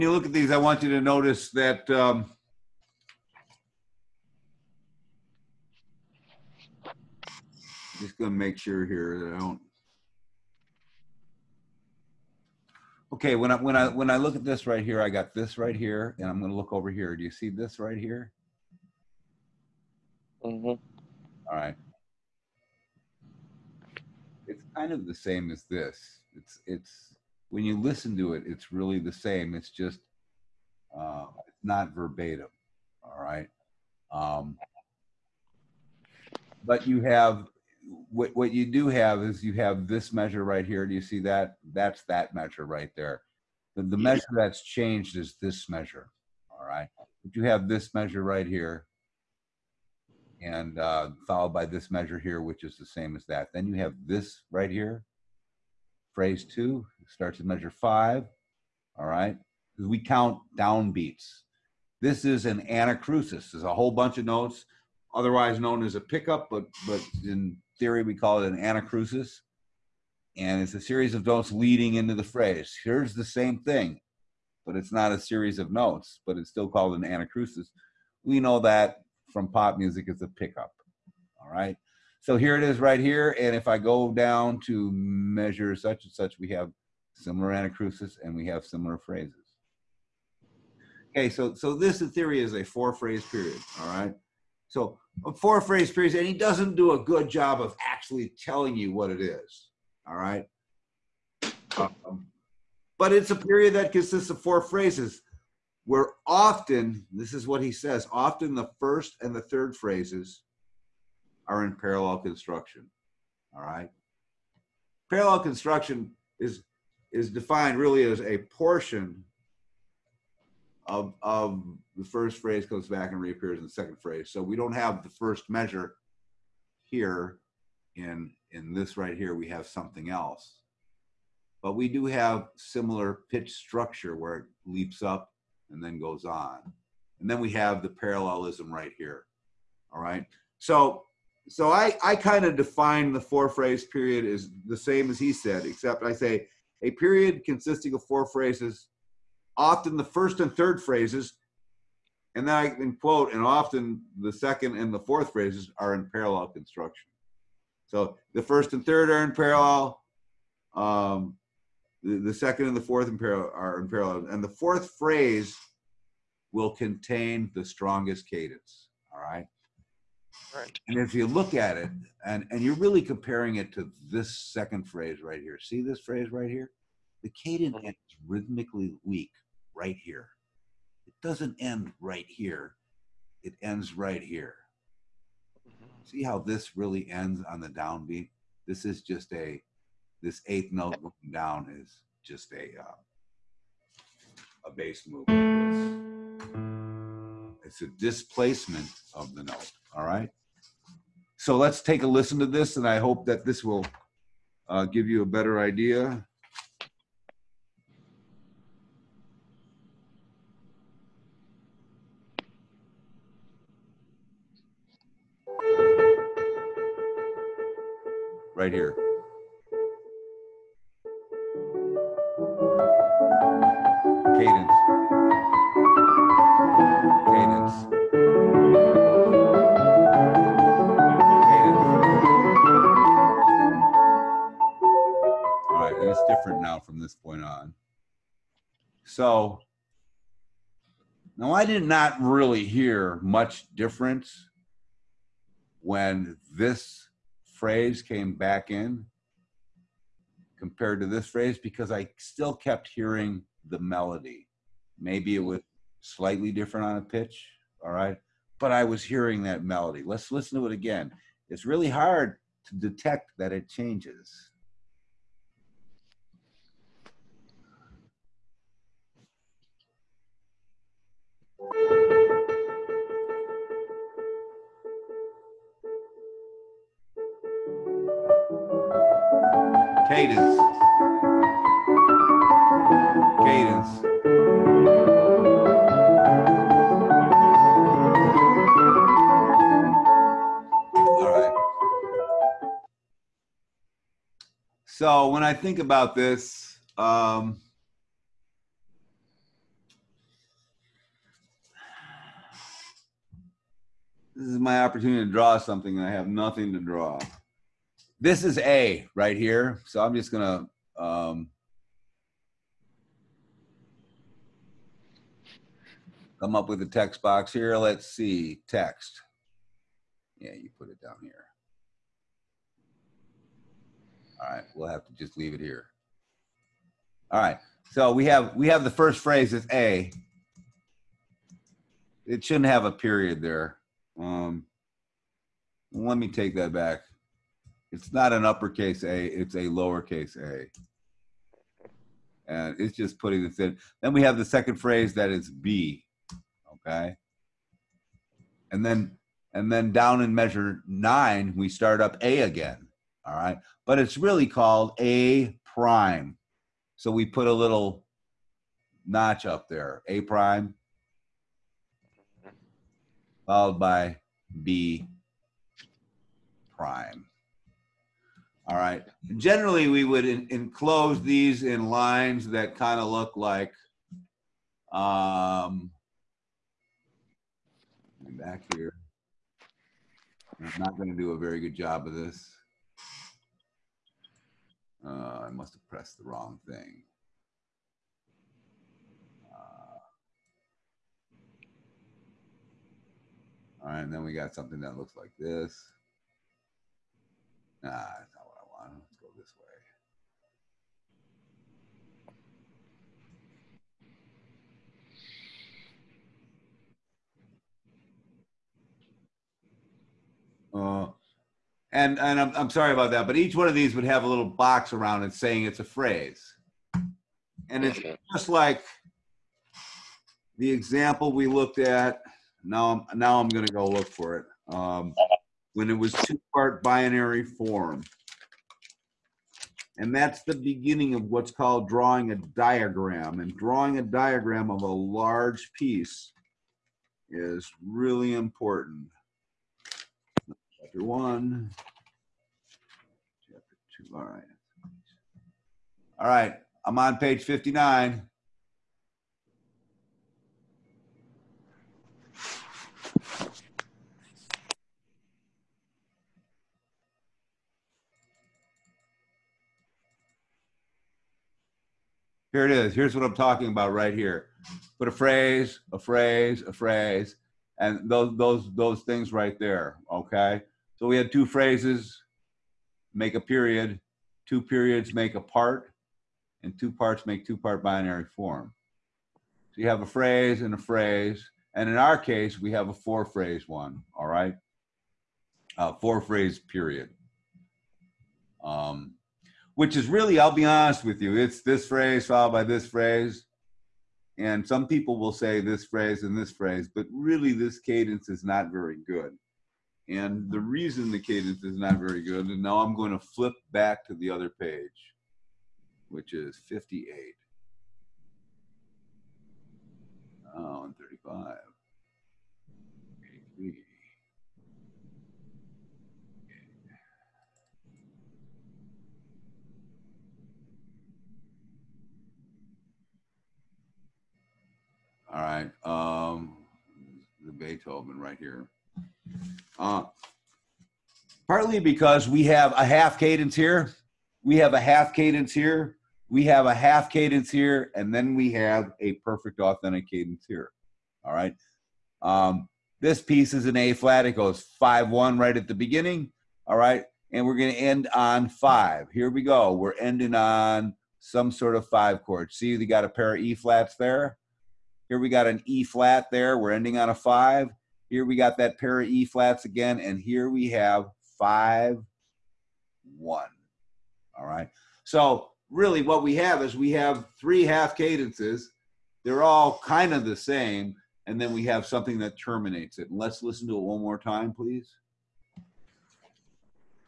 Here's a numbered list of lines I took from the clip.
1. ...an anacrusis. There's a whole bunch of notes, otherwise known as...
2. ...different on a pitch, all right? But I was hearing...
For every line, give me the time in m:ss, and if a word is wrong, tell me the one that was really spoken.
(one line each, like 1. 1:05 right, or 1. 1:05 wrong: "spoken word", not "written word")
1. 1:02 right
2. 4:16 right.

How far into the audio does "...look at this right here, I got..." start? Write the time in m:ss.
0:14.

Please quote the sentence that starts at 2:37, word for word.
So the first and third are in parallel.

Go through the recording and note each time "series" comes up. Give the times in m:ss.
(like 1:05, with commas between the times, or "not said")
1:10, 1:15.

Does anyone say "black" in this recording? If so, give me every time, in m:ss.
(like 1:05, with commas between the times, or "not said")
not said.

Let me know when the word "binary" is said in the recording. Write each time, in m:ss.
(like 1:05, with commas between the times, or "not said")
7:06, 7:57.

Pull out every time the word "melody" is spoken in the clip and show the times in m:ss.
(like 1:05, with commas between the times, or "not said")
4:13, 4:19.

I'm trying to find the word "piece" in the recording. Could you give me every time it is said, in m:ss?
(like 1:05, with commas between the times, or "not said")
7:15, 9:03.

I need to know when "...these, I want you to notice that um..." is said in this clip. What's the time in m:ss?
0:00.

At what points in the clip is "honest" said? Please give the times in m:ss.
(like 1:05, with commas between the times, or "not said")
8:10.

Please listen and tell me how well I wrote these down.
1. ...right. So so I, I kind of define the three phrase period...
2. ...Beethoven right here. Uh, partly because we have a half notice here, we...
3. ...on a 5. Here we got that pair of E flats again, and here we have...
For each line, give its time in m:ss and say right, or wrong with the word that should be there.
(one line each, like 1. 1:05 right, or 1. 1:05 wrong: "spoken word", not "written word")
1. 2:20 wrong: "four", not "three"
2. 8:47 wrong: "cadence", not "notice"
3. 9:16 right.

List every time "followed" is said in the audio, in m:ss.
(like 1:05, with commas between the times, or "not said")
0:51, 6:03, 8:12.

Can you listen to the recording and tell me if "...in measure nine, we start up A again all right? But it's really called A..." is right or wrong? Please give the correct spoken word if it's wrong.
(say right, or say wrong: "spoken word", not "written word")
right.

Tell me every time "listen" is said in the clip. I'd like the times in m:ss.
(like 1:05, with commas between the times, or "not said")
0:27, 3:22, 4:20, 9:33.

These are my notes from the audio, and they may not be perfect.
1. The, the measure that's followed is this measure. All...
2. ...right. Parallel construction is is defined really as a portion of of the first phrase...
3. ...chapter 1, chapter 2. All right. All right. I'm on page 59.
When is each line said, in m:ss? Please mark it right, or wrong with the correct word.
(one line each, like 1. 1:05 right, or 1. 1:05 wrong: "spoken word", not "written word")
1. 0:43 wrong: "changed", not "followed"
2. 1:53 right
3. 7:20 right.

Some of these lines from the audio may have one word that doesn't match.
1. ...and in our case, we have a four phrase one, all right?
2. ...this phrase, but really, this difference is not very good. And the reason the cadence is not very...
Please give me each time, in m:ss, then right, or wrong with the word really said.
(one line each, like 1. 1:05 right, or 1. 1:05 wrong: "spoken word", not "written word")
1. 8:01 right
2. 8:16 wrong: "cadence", not "difference".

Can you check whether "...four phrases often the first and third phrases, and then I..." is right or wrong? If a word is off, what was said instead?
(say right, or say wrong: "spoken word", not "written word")
right.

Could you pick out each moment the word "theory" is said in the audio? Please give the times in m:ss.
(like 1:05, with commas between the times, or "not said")
1:07, 1:32.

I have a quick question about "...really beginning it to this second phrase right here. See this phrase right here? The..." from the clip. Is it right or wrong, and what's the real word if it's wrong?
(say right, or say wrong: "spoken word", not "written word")
wrong: "comparing", not "beginning".